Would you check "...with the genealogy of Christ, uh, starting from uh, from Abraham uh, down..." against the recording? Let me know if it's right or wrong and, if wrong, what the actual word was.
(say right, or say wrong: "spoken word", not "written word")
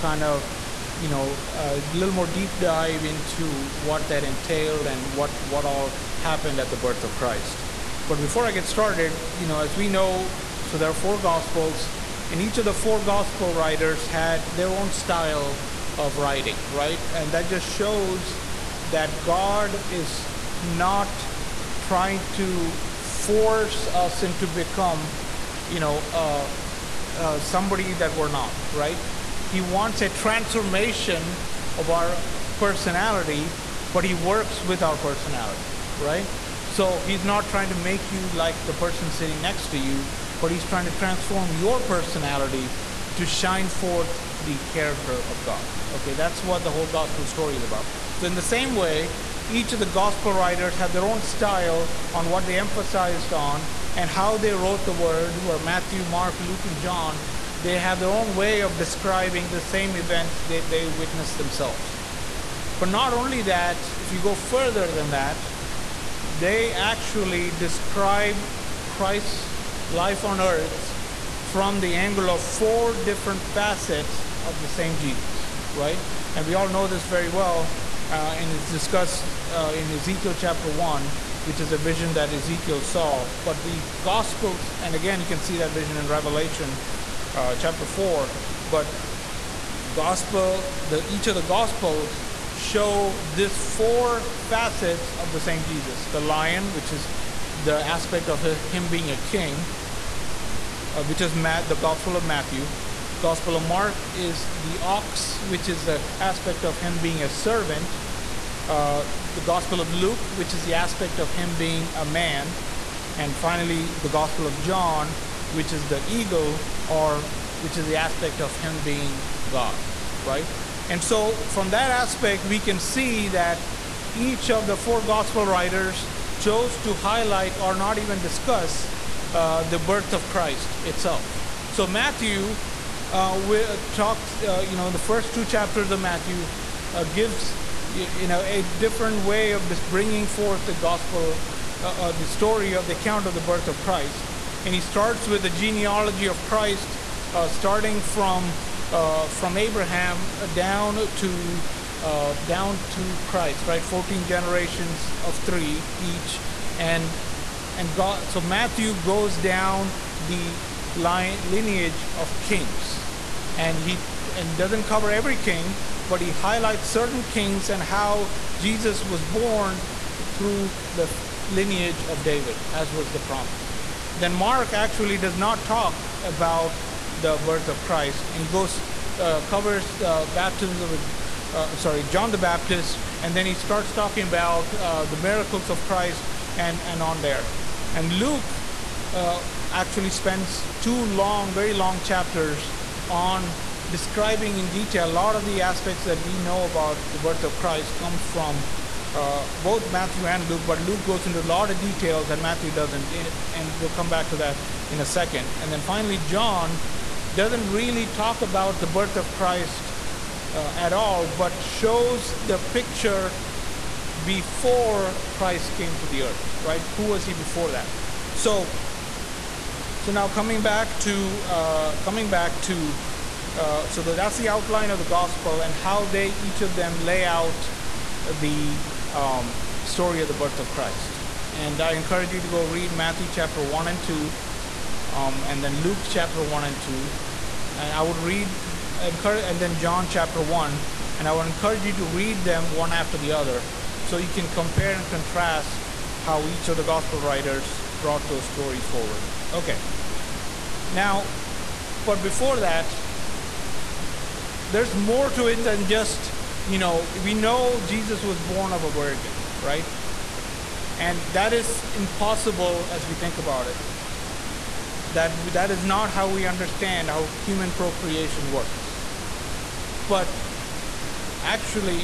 right.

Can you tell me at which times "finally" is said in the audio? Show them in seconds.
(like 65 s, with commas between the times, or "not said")
113 s, 205 s.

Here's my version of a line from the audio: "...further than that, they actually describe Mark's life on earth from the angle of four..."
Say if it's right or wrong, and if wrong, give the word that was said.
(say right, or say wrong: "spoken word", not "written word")
wrong: "Christ", not "Mark".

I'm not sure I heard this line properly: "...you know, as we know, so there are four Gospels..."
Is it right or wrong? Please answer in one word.
right.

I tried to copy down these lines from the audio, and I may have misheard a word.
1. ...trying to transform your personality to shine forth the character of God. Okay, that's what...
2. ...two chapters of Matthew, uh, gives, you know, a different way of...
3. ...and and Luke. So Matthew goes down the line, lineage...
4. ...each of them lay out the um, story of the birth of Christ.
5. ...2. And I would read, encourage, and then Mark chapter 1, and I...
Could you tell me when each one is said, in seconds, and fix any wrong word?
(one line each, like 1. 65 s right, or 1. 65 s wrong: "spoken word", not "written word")
1. 40 s right
2. 135 s right
3. 156 s wrong: "God", not "Luke"
4. 226 s right
5. 236 s wrong: "John", not "Mark".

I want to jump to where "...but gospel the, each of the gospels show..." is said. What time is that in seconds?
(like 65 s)
88 s.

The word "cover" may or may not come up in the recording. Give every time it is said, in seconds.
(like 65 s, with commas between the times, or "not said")
164 s, 179 s.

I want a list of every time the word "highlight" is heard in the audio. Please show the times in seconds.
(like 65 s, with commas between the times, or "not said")
126 s, 166 s.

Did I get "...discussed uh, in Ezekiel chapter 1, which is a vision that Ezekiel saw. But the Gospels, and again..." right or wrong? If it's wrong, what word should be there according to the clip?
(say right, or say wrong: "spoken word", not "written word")
right.